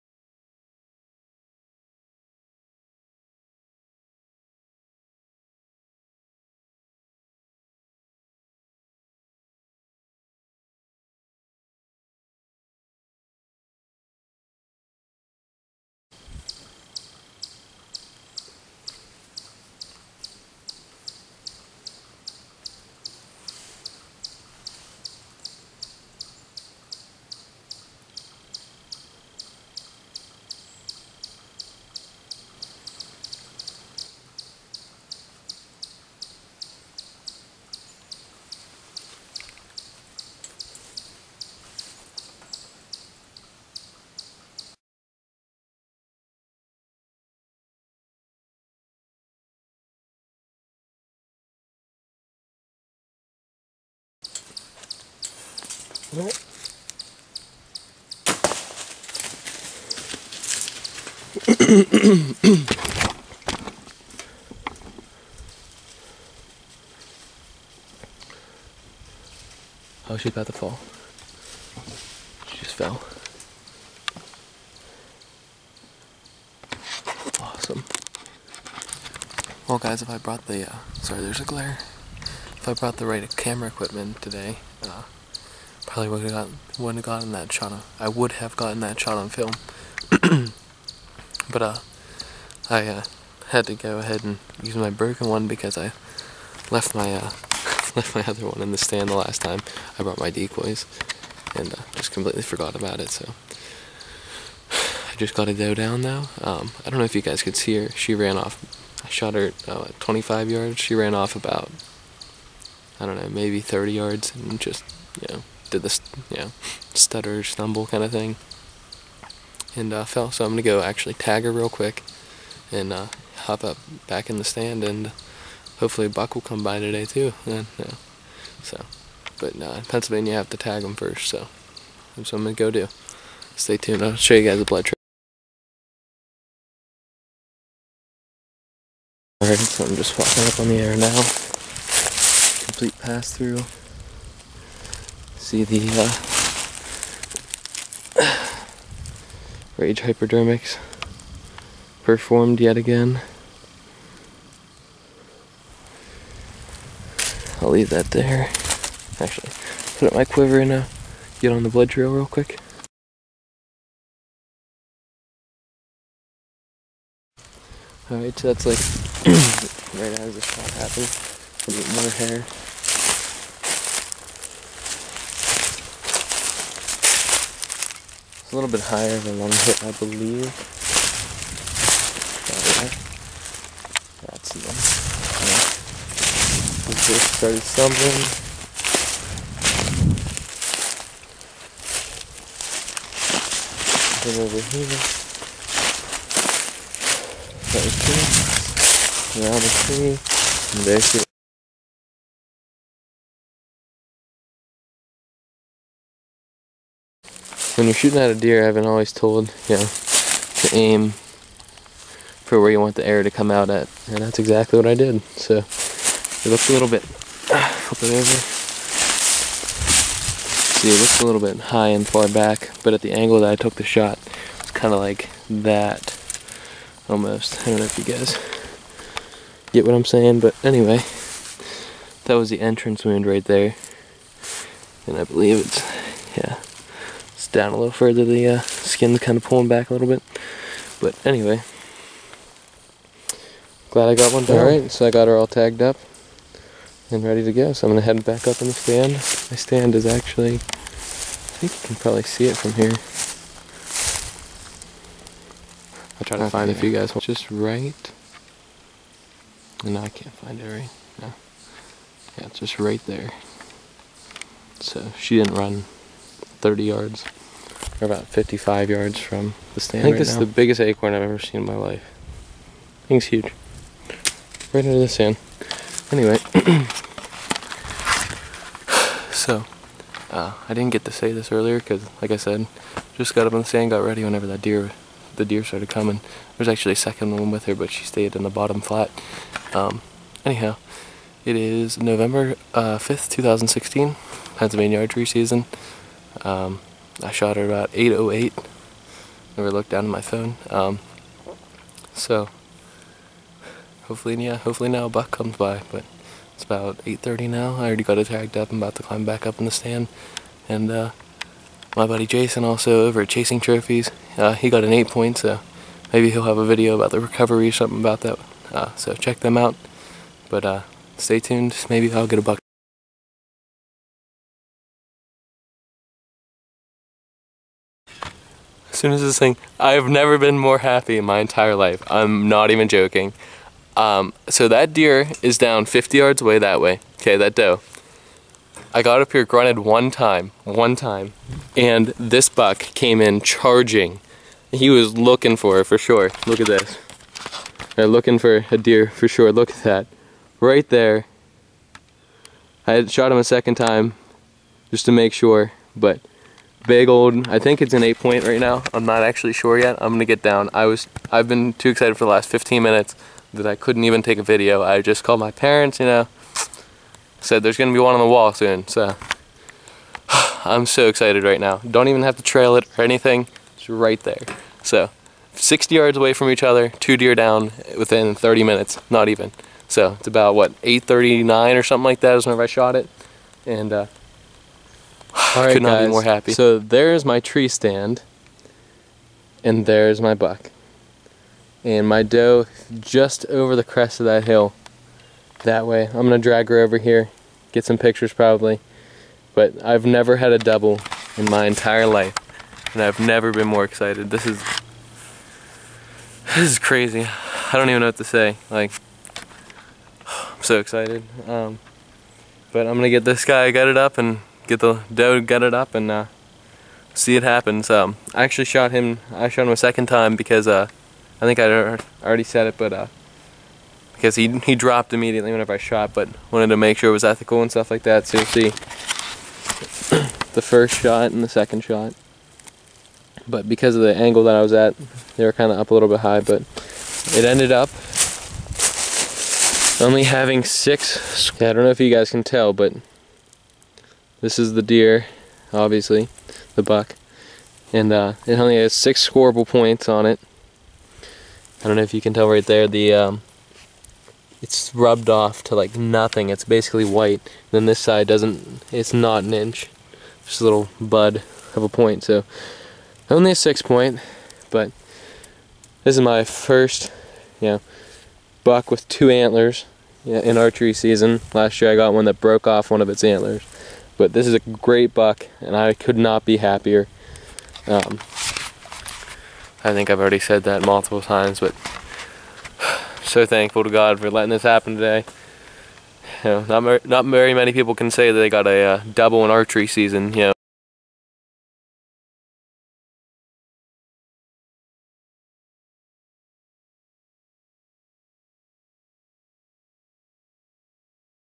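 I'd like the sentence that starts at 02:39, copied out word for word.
Actually, put up my quiver and uh, get on the blood trail real quick.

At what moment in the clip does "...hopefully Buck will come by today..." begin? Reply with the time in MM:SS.
02:05.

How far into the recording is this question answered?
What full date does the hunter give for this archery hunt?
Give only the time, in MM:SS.
04:51.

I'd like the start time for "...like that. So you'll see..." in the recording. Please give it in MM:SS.
07:07.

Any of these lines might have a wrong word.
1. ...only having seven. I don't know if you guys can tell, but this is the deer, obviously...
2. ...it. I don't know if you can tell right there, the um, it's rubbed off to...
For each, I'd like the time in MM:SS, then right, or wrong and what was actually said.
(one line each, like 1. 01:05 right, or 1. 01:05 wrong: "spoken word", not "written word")
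1. 07:19 wrong: "six", not "seven"
2. 07:30 right.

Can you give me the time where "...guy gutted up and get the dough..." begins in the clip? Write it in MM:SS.
06:53.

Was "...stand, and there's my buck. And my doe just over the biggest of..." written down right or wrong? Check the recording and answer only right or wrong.
wrong.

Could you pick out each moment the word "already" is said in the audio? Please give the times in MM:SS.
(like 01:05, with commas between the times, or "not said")
05:07, 07:02, 08:00.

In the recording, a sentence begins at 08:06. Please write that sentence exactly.
You know, not, not very many people can say that they got a uh, double in archery season.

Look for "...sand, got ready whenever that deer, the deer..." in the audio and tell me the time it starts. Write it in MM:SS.
04:43.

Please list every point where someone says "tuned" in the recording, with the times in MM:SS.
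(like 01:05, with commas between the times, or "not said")
02:13, 05:21.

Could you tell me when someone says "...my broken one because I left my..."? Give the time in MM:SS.
01:34.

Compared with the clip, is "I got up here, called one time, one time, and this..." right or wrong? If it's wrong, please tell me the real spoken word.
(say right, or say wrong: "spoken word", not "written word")
wrong: "grunted", not "called".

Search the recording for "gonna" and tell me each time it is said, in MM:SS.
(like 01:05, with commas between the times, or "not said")
02:00, 02:12, 04:07, 06:00, 06:07, 06:52.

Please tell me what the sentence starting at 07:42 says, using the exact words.
So only a six point, but this is my first, you know, buck with two antlers in archery season.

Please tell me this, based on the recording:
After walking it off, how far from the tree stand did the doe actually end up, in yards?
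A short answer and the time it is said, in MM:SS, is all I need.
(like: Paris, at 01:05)
55, at 04:28.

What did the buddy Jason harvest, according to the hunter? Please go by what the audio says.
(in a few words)
An 8 point.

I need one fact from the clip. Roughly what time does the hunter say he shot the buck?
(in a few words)
8:39.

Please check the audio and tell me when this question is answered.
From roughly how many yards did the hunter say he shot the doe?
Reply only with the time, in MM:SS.
01:49.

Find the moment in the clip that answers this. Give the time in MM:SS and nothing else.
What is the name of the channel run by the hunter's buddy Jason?
05:13.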